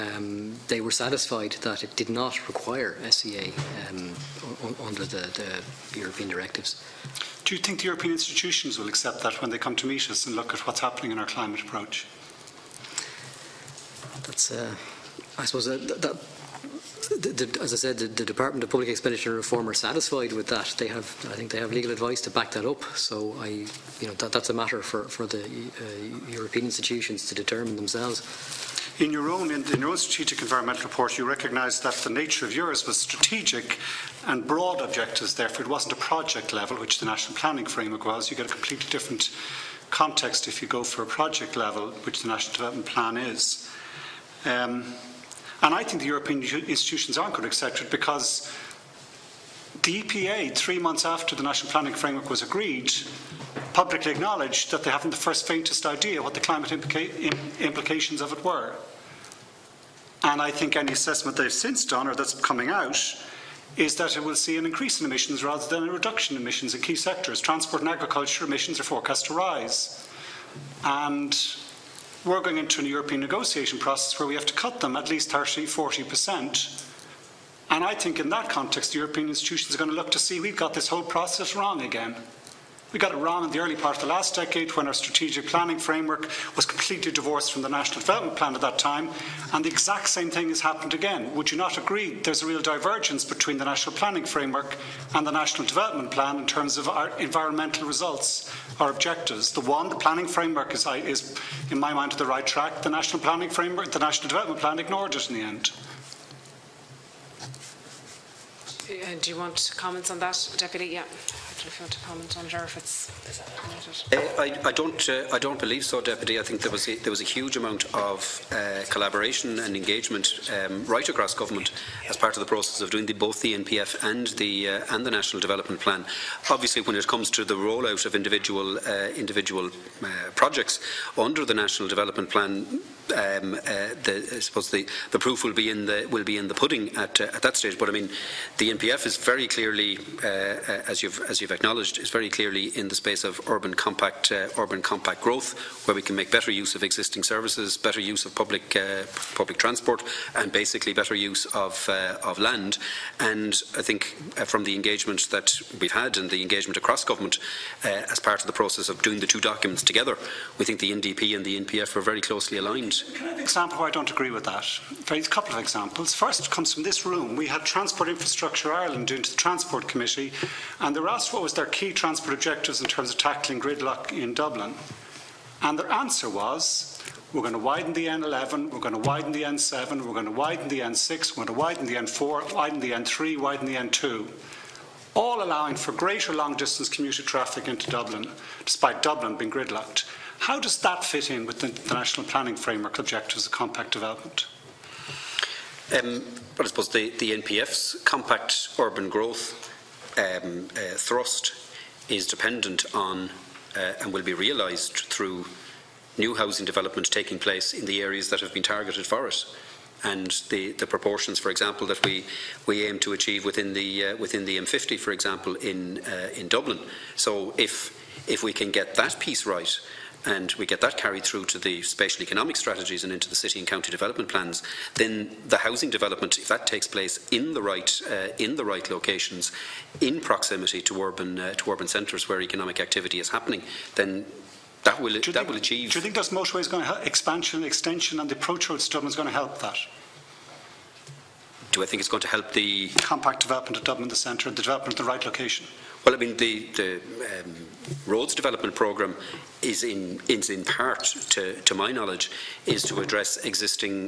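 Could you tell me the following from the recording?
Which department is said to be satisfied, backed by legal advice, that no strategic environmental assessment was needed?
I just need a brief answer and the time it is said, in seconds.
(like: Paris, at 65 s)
Department of Public Expenditure Reform, at 18 s.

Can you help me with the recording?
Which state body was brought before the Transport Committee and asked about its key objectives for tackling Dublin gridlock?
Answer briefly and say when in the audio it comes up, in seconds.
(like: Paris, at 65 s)
Transport Infrastructure Ireland, at 167 s.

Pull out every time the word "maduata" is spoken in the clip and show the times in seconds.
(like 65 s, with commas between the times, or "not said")
not said.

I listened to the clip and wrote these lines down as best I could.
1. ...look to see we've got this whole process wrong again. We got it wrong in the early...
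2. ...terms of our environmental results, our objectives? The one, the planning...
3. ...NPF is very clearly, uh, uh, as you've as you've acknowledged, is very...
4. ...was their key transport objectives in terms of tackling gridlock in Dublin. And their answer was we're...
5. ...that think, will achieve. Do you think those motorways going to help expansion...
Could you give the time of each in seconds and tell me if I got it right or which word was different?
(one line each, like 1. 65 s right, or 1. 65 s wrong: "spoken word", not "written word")
1. 79 s right
2. 96 s right
3. 138 s right
4. 171 s right
5. 235 s right.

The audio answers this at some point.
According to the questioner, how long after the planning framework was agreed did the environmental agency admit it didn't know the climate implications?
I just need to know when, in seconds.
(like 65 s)
50 s.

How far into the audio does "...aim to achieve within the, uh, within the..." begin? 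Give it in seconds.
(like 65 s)
212 s.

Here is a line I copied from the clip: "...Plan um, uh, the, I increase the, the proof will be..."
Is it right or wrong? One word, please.
wrong.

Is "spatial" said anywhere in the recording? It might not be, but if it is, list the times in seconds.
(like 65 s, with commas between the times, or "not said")
221 s.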